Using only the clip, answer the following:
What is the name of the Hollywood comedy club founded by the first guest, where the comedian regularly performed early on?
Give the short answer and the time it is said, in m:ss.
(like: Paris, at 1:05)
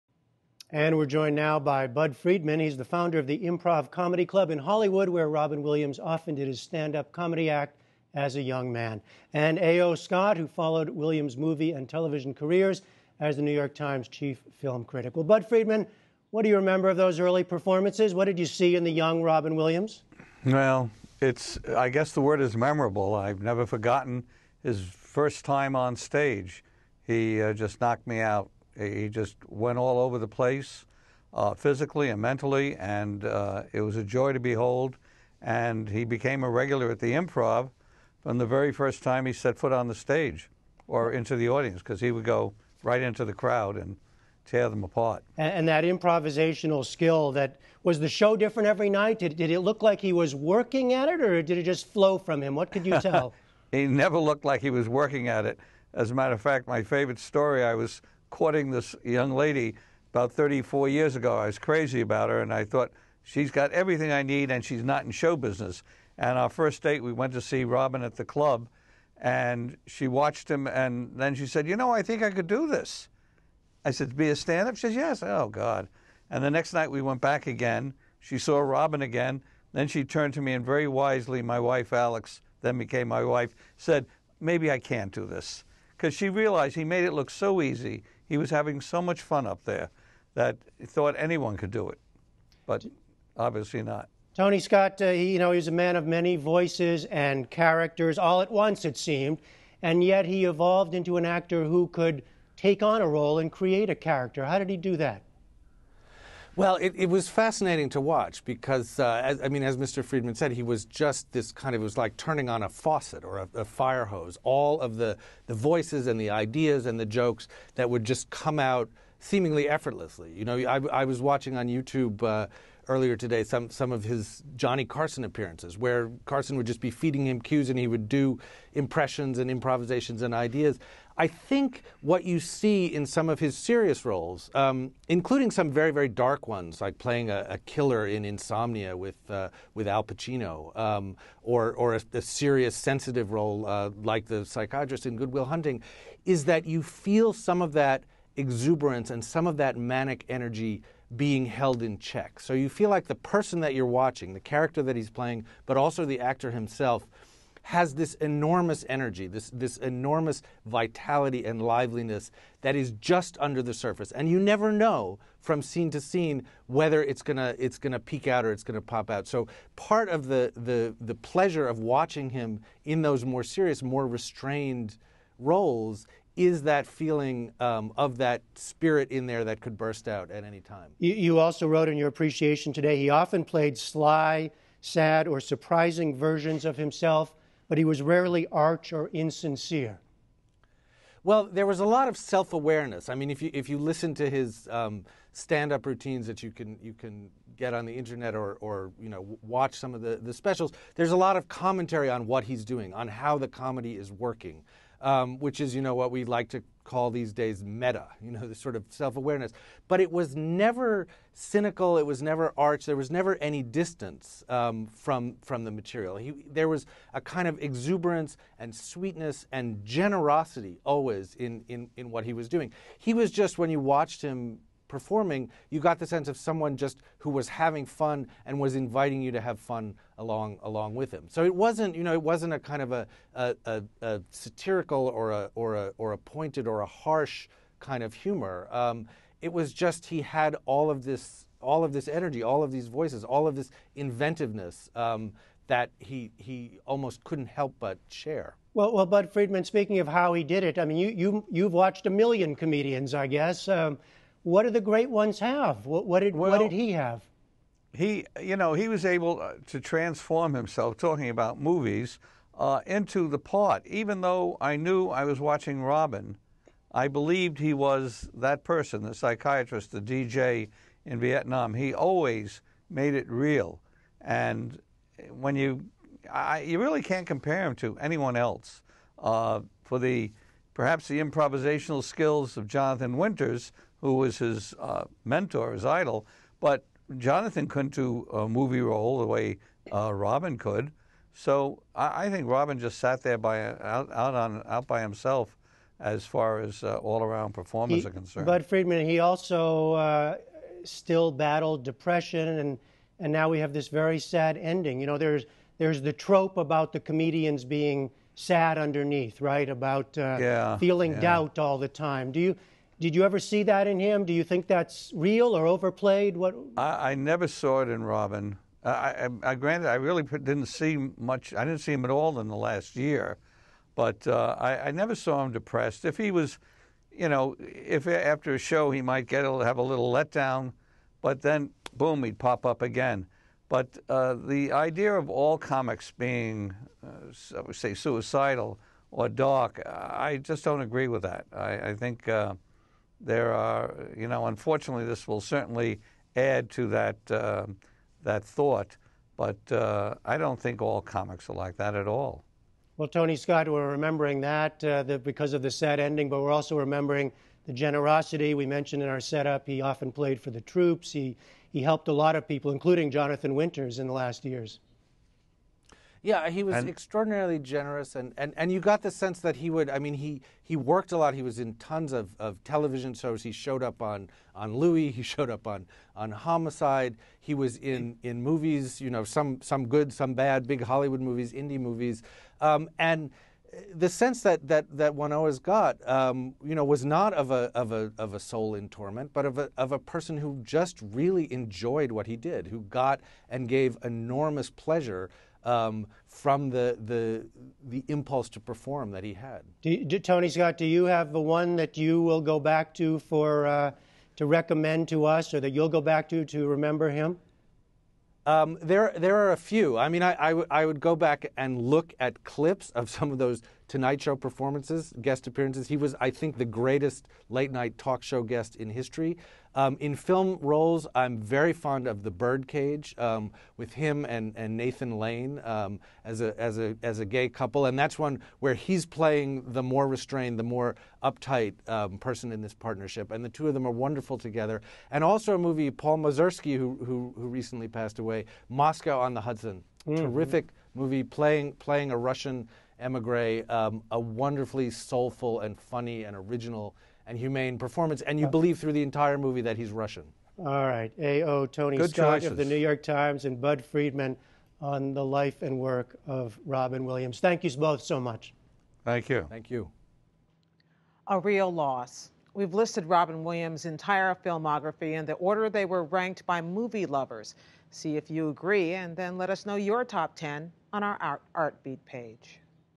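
Improv Comedy Club, at 0:03.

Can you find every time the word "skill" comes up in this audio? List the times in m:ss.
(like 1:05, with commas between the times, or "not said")
0:46, 4:42.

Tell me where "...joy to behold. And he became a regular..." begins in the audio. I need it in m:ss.
0:34.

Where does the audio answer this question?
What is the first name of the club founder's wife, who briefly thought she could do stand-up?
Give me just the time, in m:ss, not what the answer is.
1:21.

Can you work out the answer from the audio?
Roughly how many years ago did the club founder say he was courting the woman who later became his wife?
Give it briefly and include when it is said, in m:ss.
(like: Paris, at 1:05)
34, at 1:00.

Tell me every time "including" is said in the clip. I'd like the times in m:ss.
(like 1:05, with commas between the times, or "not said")
2:15, 6:02.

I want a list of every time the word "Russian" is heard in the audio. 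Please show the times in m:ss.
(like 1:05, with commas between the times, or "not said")
7:22, 7:29.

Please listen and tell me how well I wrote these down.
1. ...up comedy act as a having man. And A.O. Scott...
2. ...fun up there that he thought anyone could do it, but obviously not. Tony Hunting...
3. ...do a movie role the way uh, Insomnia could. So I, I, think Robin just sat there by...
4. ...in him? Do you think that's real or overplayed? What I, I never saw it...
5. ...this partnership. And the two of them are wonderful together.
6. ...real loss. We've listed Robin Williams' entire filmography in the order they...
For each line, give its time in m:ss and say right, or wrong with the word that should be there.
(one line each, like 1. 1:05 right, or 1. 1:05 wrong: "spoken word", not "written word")
1. 0:06 wrong: "young", not "having"
2. 1:29 wrong: "Scott", not "Hunting"
3. 4:47 wrong: "Robin", not "Insomnia"
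4. 5:13 right
5. 7:12 right
6. 7:41 right.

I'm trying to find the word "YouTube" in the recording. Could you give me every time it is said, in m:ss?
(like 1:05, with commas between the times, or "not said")
2:01.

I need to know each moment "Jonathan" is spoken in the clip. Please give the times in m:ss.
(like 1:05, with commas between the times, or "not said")
4:42, 4:47, 6:03.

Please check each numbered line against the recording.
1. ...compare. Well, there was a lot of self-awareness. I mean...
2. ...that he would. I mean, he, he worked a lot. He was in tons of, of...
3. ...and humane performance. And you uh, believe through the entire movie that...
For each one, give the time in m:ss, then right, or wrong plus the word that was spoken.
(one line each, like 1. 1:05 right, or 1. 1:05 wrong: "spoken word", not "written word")
1. 3:09 wrong: "insincere", not "compare"
2. 6:09 right
3. 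7:27 right.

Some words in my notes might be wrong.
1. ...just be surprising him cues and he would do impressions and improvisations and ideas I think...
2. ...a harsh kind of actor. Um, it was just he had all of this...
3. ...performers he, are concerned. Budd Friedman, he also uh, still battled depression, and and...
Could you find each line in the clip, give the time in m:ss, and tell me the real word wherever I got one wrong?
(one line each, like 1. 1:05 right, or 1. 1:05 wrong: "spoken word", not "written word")
1. 2:06 wrong: "feeding", not "surprising"
2. 3:56 wrong: "humor", not "actor"
3. 4:57 right.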